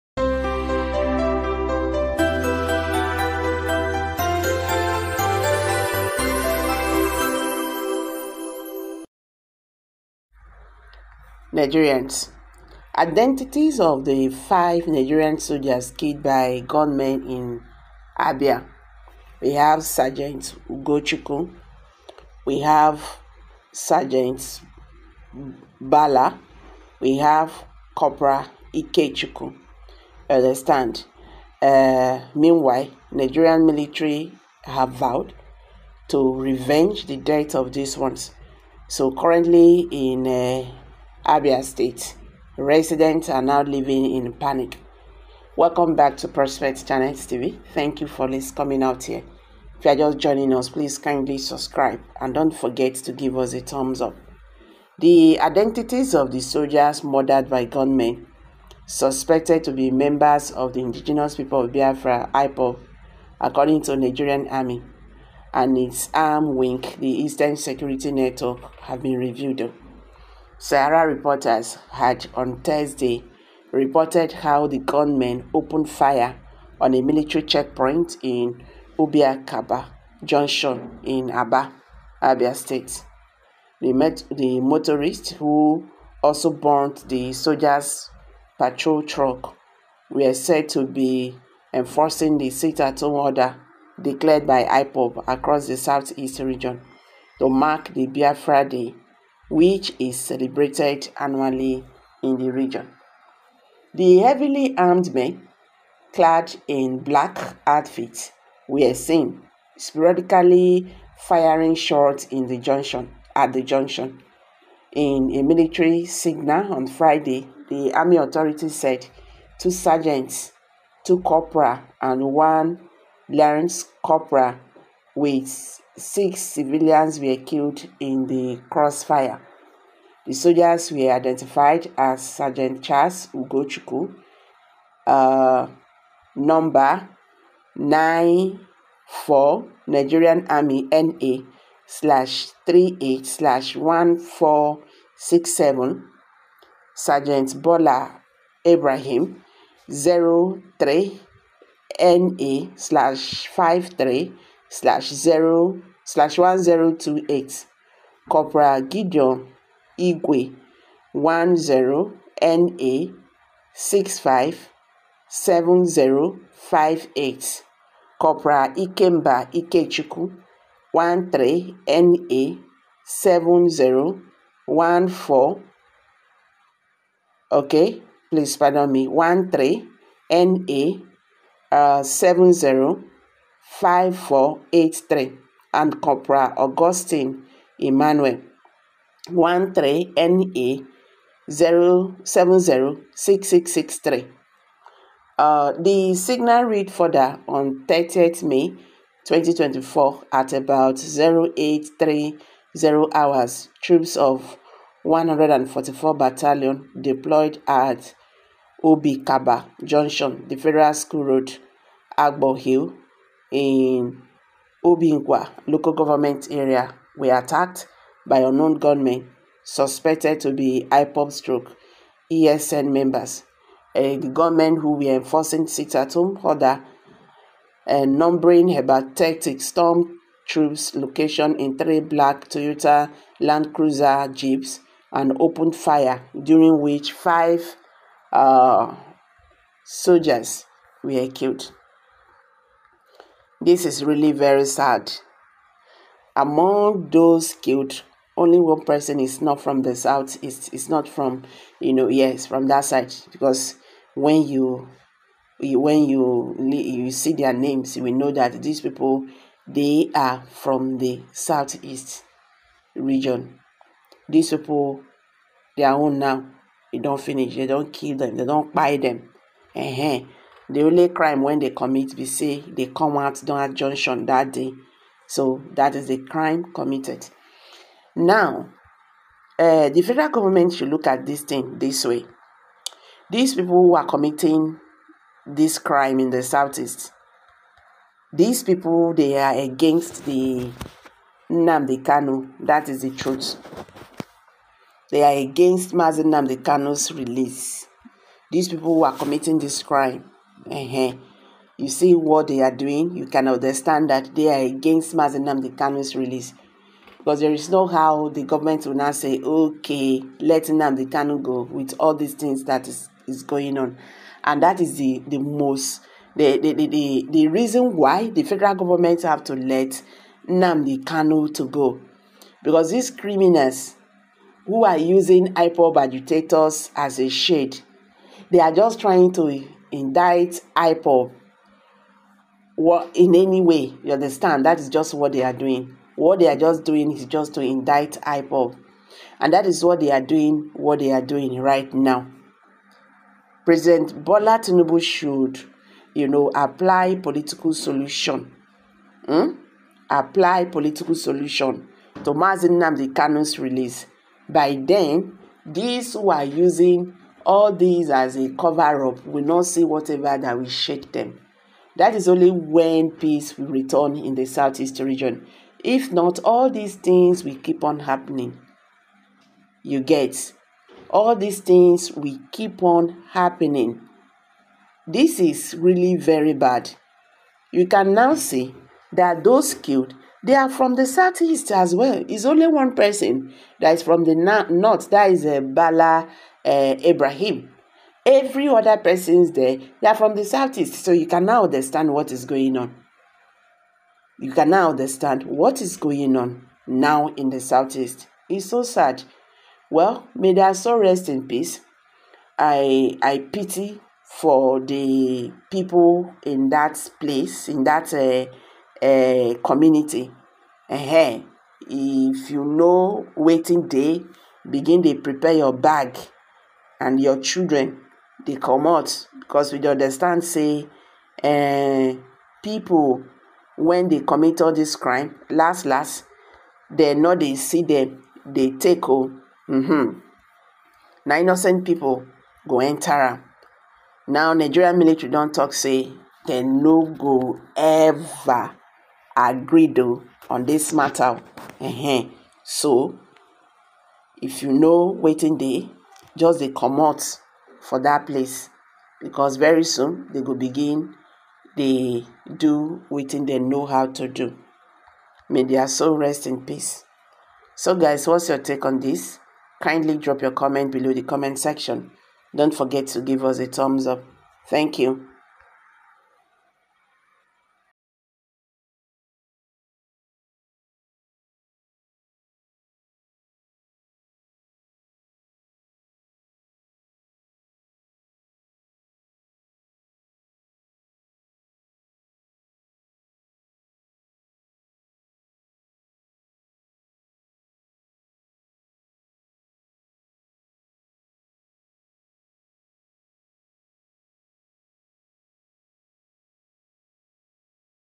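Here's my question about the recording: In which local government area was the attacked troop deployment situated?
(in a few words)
Obingwa.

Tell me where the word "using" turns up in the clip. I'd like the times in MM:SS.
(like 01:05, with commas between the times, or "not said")
05:24, 05:56.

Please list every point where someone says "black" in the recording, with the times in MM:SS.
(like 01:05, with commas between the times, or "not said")
01:46, 03:51.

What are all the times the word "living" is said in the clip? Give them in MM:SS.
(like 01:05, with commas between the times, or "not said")
00:43.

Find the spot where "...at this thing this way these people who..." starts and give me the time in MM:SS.
04:41.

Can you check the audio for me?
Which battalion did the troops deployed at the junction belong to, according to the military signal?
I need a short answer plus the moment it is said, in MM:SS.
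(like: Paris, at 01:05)
144 Battalion, at 03:25.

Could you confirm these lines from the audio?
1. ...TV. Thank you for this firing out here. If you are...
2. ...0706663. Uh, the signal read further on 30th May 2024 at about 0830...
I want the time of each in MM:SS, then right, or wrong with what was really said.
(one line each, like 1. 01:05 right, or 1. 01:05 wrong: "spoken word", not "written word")
1. 00:47 wrong: "coming", not "firing"
2. 03:11 right.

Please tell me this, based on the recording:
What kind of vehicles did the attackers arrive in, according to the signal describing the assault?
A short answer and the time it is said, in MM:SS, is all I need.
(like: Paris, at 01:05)
Toyota Land Cruiser jeeps, at 03:52.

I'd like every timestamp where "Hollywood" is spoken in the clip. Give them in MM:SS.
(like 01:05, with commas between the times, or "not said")
not said.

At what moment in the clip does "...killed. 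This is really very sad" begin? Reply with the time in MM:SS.
04:01.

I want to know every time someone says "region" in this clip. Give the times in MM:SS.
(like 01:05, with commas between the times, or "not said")
01:36, 01:42, 04:22, 06:04.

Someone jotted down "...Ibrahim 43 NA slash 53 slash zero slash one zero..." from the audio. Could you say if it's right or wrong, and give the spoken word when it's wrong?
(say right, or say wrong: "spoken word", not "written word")
wrong: "03", not "43".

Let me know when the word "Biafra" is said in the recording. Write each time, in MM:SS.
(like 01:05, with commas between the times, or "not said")
01:01, 01:38.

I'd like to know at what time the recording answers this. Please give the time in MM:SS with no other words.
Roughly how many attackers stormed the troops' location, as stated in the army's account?
03:49.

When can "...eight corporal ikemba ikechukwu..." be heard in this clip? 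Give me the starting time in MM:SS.
02:47.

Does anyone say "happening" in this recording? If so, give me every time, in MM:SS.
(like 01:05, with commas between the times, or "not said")
06:08, 06:13.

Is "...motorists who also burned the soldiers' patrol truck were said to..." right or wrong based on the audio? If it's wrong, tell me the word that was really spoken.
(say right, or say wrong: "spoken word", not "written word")
right.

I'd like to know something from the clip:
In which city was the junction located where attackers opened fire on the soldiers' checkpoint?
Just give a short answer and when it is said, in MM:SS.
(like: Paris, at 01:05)
Aba, at 01:21.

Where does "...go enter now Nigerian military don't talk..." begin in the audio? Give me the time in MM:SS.
07:12.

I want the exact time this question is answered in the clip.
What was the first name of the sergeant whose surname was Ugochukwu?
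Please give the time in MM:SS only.
02:12.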